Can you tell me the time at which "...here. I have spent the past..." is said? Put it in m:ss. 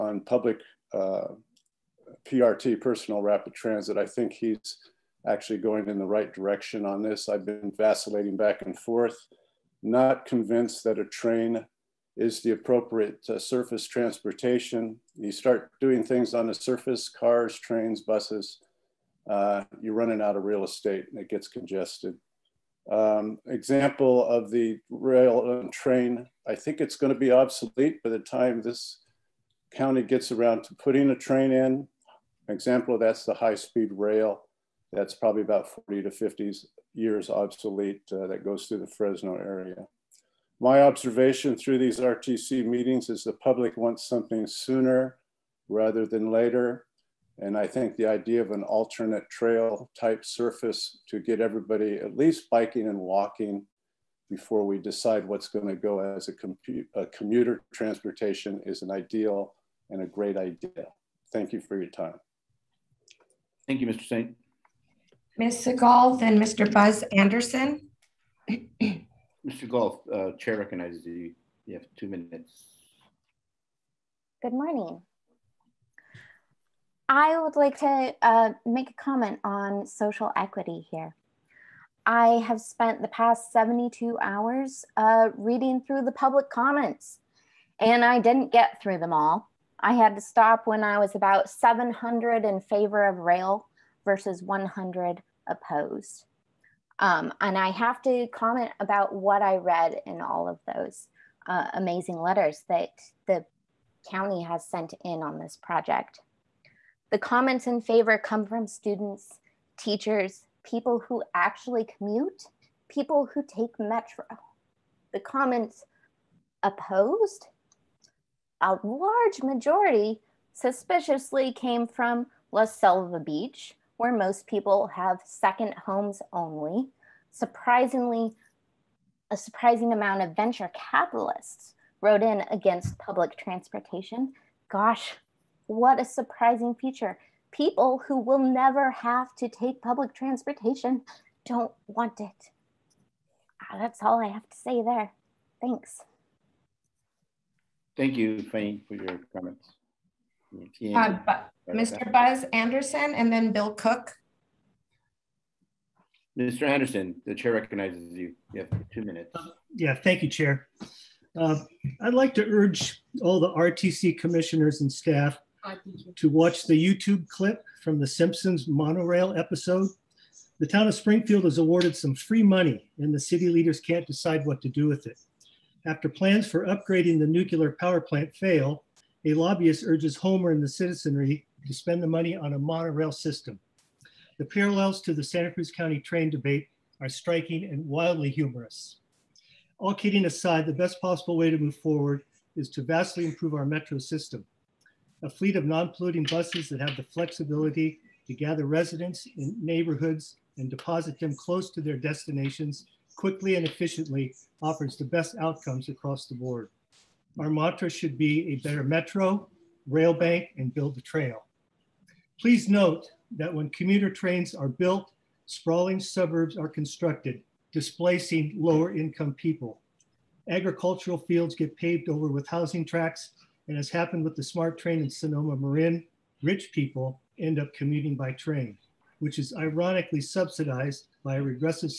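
1:20.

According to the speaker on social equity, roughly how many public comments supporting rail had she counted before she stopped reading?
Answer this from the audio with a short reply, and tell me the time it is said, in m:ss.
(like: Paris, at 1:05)
700, at 1:31.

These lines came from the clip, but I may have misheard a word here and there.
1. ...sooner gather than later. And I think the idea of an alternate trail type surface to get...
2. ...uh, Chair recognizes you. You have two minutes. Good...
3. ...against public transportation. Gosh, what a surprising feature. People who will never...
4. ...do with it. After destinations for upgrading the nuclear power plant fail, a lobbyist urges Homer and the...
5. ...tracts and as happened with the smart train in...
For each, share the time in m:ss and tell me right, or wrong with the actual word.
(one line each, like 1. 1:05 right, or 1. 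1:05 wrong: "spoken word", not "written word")
1. 0:44 wrong: "rather", not "gather"
2. 1:10 right
3. 2:12 right
4. 2:54 wrong: "plans", not "destinations"
5. 3:42 right.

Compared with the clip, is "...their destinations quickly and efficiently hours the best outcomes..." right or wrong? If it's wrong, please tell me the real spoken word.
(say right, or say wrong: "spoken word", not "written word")
wrong: "offers", not "hours".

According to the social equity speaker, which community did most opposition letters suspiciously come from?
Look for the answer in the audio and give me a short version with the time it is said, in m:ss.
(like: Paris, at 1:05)
La Selva Beach, at 2:02.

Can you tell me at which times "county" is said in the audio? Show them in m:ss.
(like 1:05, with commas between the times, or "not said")
0:29, 1:44, 3:05.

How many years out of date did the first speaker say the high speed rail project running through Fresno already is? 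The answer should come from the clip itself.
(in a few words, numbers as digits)
40 to 50.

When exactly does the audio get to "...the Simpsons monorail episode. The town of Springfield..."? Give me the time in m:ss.
2:47.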